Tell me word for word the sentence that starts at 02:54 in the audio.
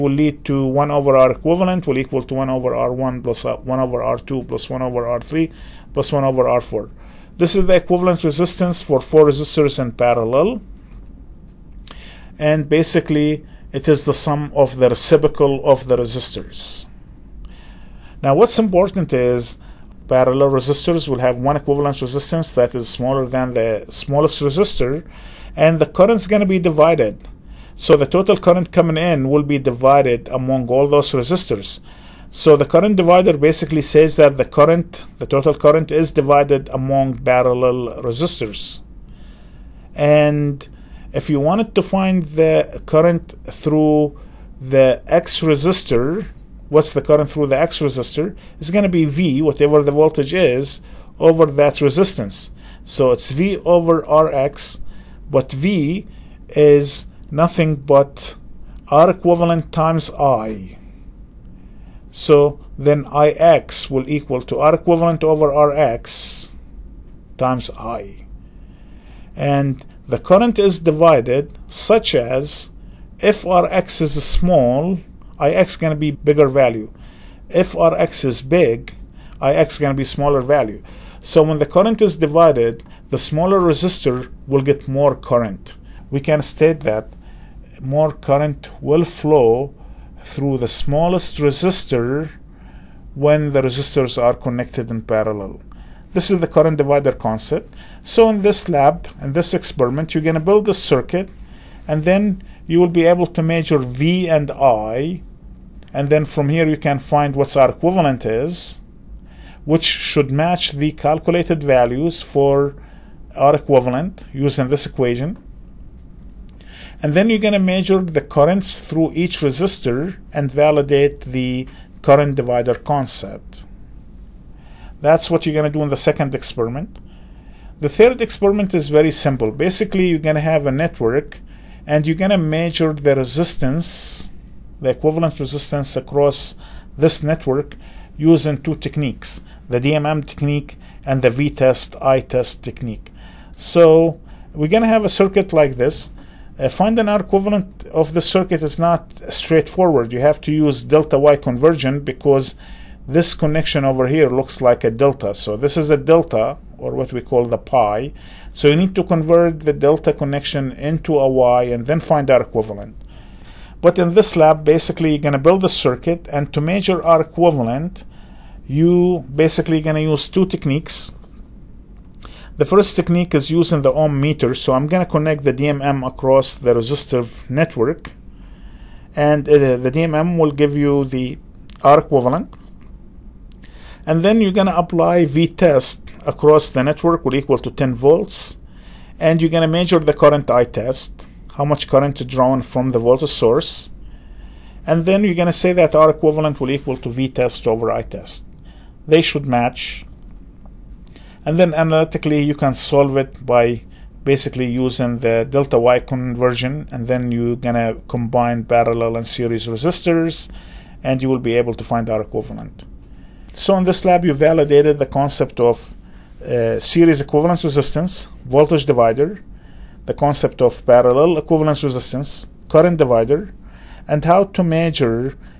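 So I'm going to connect the DMM across the resistive network.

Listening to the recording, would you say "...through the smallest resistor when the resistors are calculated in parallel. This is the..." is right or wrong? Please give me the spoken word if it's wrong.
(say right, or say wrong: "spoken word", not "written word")
wrong: "connected", not "calculated".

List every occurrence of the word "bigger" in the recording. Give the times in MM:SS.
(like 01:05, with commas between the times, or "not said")
01:16.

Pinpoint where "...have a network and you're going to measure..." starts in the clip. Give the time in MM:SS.
02:10.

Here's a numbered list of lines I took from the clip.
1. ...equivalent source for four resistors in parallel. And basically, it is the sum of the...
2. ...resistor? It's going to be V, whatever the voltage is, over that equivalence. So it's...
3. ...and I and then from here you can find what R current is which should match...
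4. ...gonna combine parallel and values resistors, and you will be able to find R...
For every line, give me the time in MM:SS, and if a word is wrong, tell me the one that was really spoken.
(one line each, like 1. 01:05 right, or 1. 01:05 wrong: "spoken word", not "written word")
1. 00:07 wrong: "resistance", not "source"
2. 00:47 wrong: "resistance", not "equivalence"
3. 01:44 wrong: "equivalent", not "current"
4. 03:27 wrong: "series", not "values".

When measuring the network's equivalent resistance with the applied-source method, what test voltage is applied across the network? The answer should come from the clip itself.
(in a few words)
10 volts.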